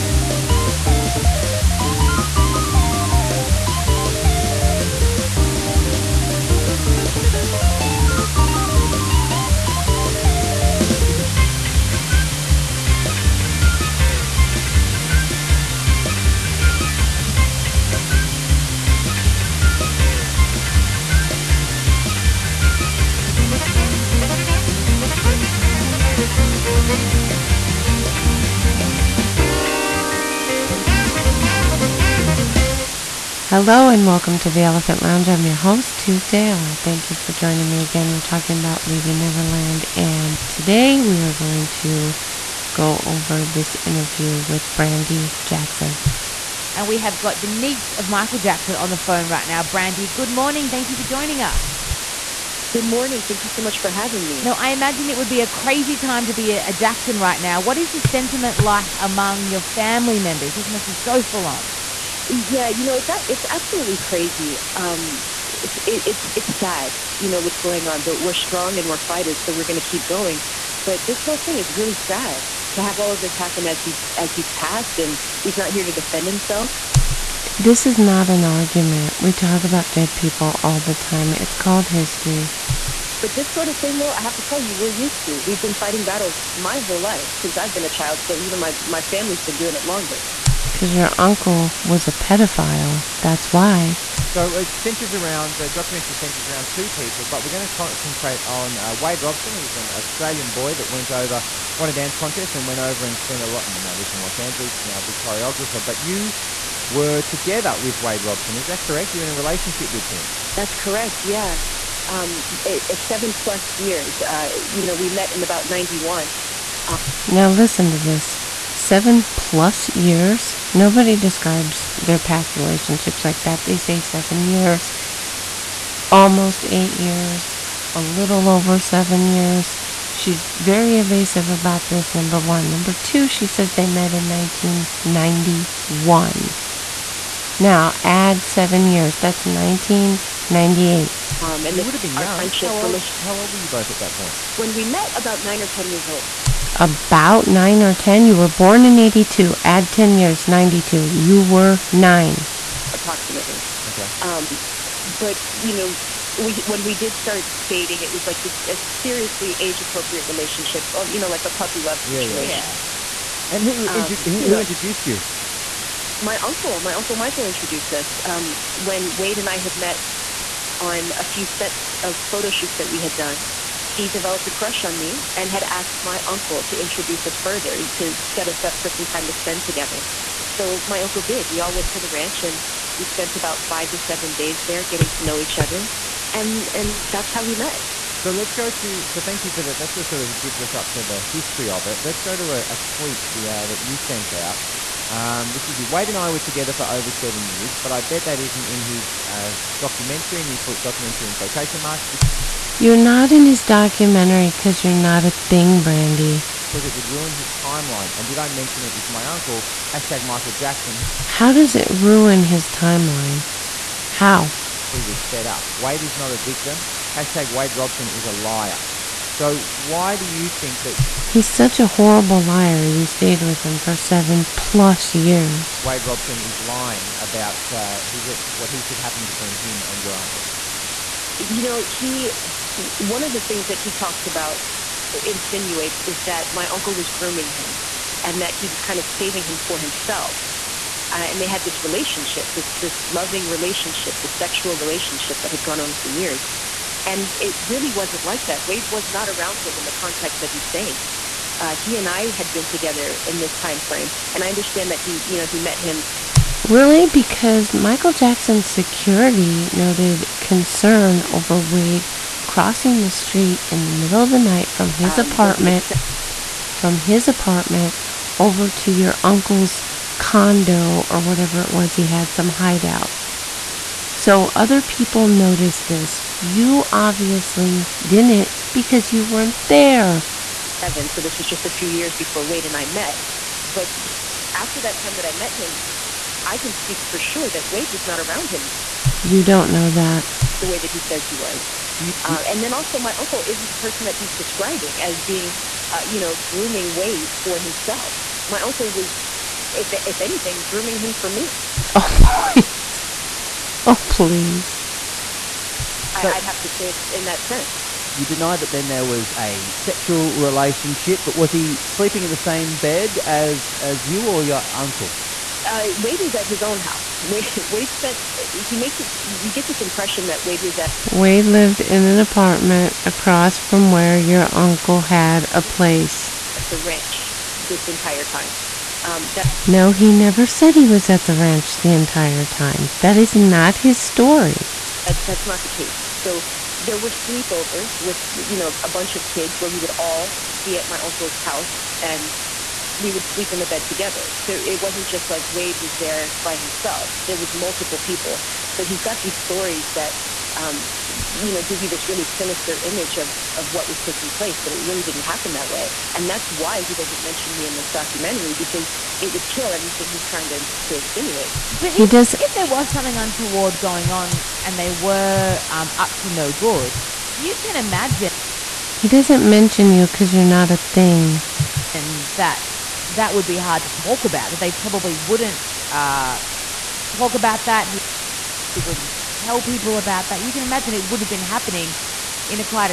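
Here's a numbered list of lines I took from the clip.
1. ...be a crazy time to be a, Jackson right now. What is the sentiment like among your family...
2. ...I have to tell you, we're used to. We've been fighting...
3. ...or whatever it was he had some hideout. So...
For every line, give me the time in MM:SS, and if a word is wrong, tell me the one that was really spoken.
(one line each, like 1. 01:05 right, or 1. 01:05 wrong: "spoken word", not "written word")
1. 00:55 right
2. 01:24 right
3. 04:31 right.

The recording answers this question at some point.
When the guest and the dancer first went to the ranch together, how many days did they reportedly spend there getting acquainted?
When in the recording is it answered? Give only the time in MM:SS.
03:03.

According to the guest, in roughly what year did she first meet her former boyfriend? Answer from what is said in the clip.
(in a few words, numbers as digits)
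1991.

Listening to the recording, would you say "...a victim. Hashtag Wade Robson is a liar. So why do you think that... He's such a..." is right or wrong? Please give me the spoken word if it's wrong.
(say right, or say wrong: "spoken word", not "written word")
right.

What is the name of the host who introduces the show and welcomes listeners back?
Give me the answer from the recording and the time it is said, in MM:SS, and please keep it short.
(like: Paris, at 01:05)
Tuesday, at 00:35.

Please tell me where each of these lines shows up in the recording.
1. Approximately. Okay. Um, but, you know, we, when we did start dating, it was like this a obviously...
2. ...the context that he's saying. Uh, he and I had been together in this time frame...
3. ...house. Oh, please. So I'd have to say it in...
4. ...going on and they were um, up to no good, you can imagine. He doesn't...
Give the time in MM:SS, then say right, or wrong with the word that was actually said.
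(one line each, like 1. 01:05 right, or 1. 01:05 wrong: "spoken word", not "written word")
1. 02:32 wrong: "seriously", not "obviously"
2. 04:09 right
3. 05:02 wrong: "please", not "house"
4. 06:03 right.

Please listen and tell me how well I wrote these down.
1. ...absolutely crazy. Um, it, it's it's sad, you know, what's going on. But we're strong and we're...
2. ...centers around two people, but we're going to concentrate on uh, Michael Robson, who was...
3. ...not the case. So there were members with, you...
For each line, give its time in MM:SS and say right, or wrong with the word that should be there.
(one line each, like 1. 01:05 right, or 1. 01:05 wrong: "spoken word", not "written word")
1. 01:03 right
2. 01:36 wrong: "Wade", not "Michael"
3. 05:35 wrong: "sleepovers", not "members".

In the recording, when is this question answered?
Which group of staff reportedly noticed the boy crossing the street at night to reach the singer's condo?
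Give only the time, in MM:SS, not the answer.
04:17.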